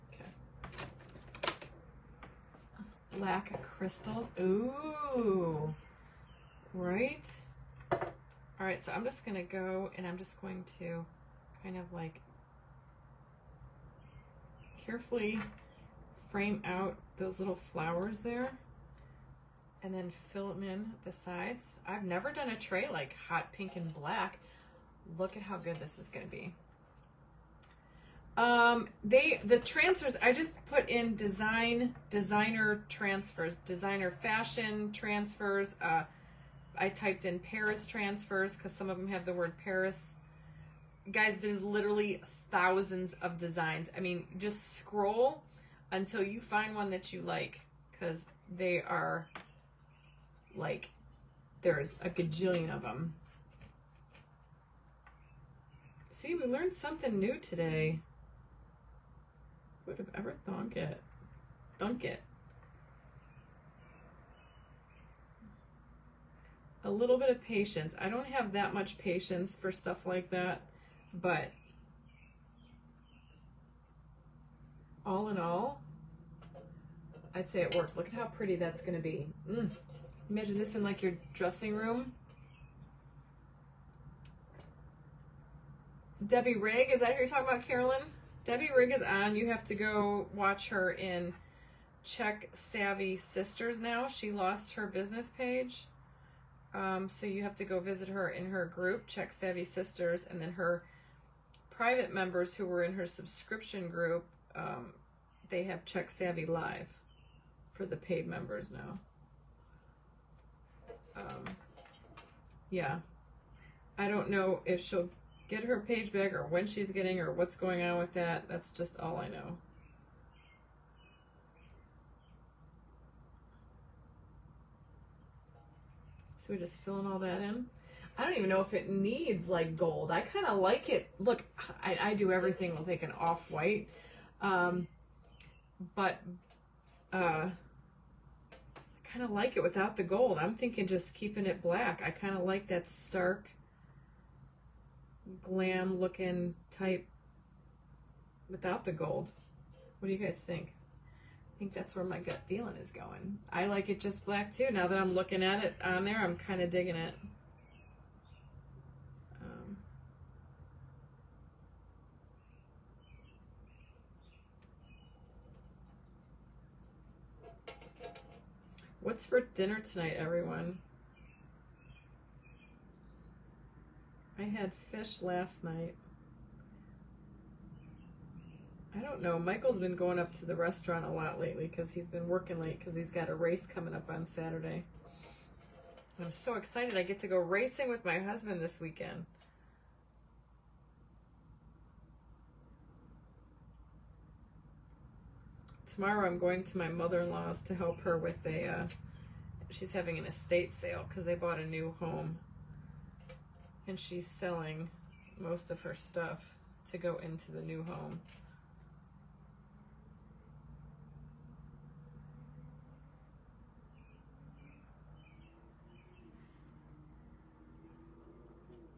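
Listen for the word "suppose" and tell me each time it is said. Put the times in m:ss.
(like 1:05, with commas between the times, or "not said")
not said.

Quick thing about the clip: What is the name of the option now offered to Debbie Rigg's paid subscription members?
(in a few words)
Check Savvy Live.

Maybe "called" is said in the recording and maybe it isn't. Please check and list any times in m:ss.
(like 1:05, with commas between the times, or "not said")
not said.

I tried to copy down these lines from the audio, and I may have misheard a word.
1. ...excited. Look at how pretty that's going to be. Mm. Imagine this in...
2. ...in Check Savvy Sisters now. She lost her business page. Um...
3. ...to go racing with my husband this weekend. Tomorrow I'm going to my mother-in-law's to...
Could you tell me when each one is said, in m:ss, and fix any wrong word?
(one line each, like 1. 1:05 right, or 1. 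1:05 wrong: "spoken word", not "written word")
1. 1:17 wrong: "worked", not "excited"
2. 1:30 right
3. 3:07 right.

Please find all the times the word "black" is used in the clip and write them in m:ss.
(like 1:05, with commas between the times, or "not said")
0:03, 0:23, 2:21, 2:34.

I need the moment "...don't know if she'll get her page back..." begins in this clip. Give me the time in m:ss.
1:54.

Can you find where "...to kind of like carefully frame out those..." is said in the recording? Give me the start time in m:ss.
0:10.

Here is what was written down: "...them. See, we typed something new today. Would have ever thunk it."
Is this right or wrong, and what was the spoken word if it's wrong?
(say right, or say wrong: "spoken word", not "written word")
wrong: "learned", not "typed".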